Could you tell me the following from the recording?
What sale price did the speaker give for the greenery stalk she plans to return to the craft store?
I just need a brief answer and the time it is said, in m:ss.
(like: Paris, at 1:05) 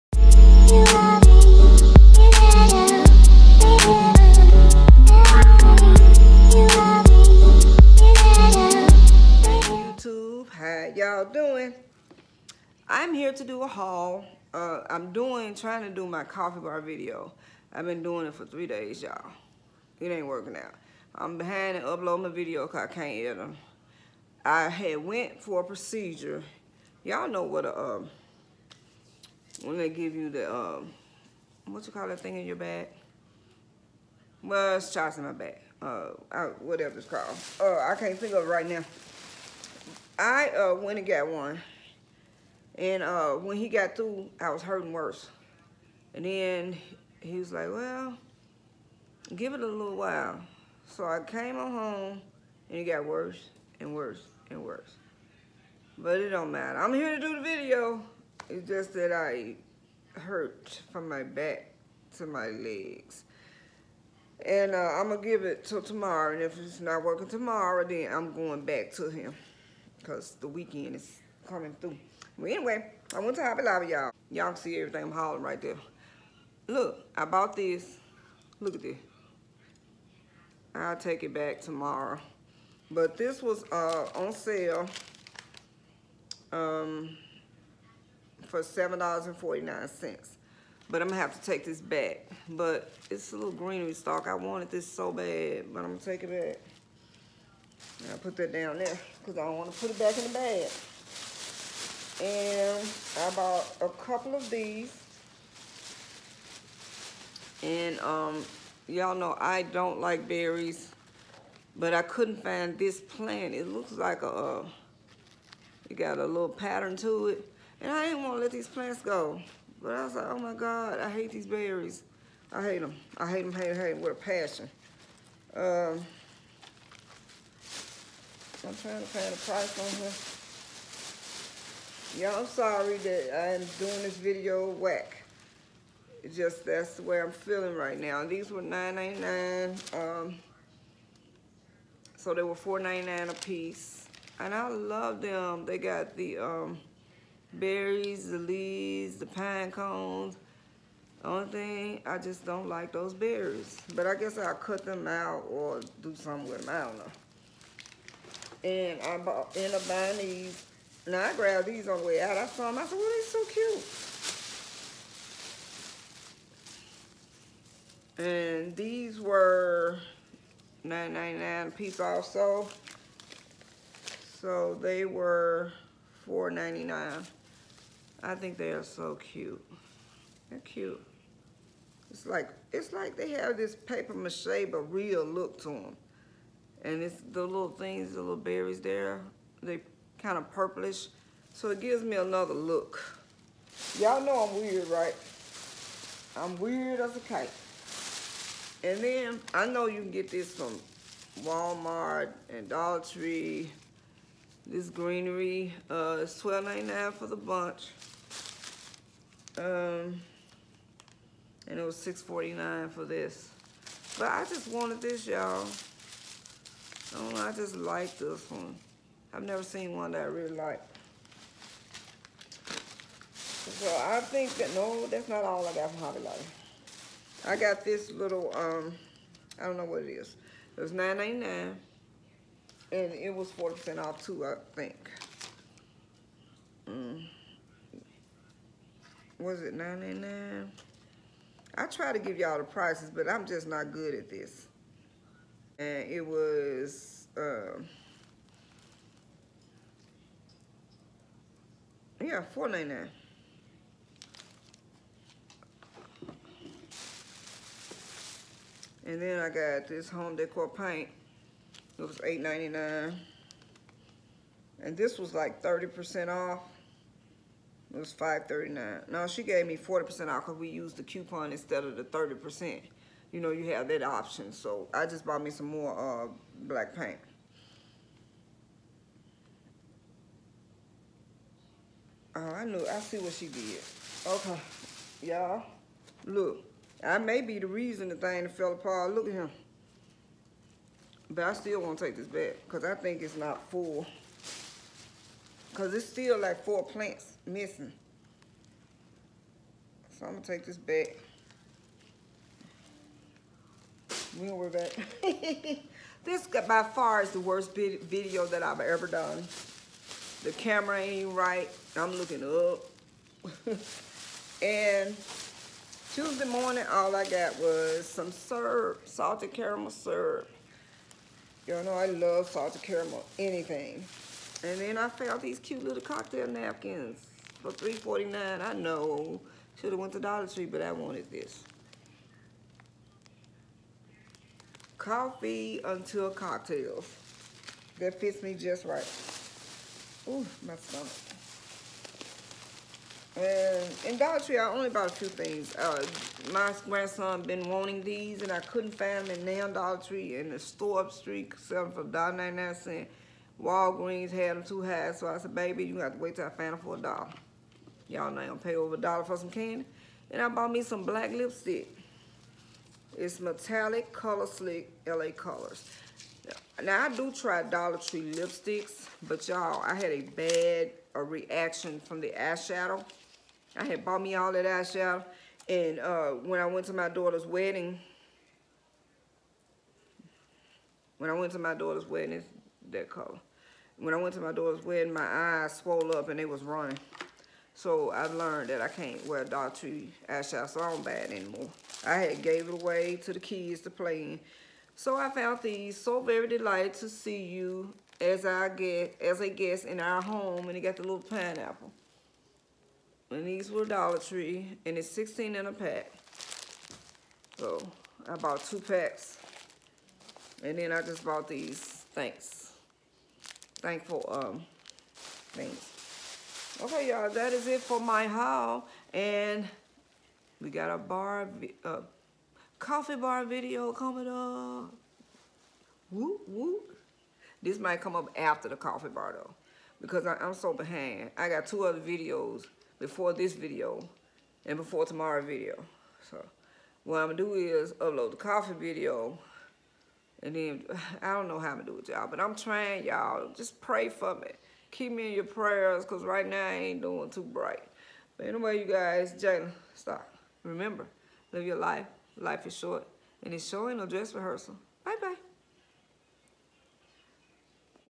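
$7.49, at 1:28.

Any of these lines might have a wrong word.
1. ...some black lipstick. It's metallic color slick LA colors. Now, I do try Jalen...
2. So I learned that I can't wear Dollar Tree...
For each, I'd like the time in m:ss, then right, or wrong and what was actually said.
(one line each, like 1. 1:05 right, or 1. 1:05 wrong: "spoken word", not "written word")
1. 6:00 wrong: "Dollar", not "Jalen"
2. 6:27 right.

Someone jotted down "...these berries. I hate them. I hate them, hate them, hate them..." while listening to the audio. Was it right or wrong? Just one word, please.
right.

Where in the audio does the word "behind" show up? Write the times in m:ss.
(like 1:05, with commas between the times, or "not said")
0:21, 7:10.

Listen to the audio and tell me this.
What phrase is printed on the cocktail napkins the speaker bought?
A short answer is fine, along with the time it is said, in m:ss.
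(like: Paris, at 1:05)
Coffee until cocktails, at 5:34.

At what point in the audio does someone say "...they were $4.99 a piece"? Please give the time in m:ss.
2:22.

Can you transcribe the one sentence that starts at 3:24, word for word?
This greenery uh, is twelve ninety nine for the bunch.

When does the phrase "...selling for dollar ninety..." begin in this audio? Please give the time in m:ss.
5:51.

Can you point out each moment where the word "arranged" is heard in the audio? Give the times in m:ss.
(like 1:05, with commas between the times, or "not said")
not said.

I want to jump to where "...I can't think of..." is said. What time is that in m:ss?
0:37.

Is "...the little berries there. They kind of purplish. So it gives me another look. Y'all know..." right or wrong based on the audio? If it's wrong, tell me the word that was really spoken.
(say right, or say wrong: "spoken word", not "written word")
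right.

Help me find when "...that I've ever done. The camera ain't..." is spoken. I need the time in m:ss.
5:08.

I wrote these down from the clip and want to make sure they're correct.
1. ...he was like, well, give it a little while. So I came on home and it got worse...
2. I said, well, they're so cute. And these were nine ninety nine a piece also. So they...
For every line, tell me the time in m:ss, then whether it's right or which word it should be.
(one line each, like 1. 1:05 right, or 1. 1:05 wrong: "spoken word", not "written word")
1. 0:47 right
2. 2:42 right.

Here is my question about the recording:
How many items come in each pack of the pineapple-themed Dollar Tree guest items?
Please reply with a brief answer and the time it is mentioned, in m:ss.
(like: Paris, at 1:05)
16, at 6:45.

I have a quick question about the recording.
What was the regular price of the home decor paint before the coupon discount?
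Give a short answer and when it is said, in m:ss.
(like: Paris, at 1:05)
$8.99, at 4:22.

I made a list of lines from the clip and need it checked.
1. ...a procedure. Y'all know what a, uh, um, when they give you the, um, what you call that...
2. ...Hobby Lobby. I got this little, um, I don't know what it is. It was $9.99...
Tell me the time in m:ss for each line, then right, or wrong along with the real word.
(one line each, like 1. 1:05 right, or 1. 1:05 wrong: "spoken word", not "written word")
1. 0:25 right
2. 3:46 right.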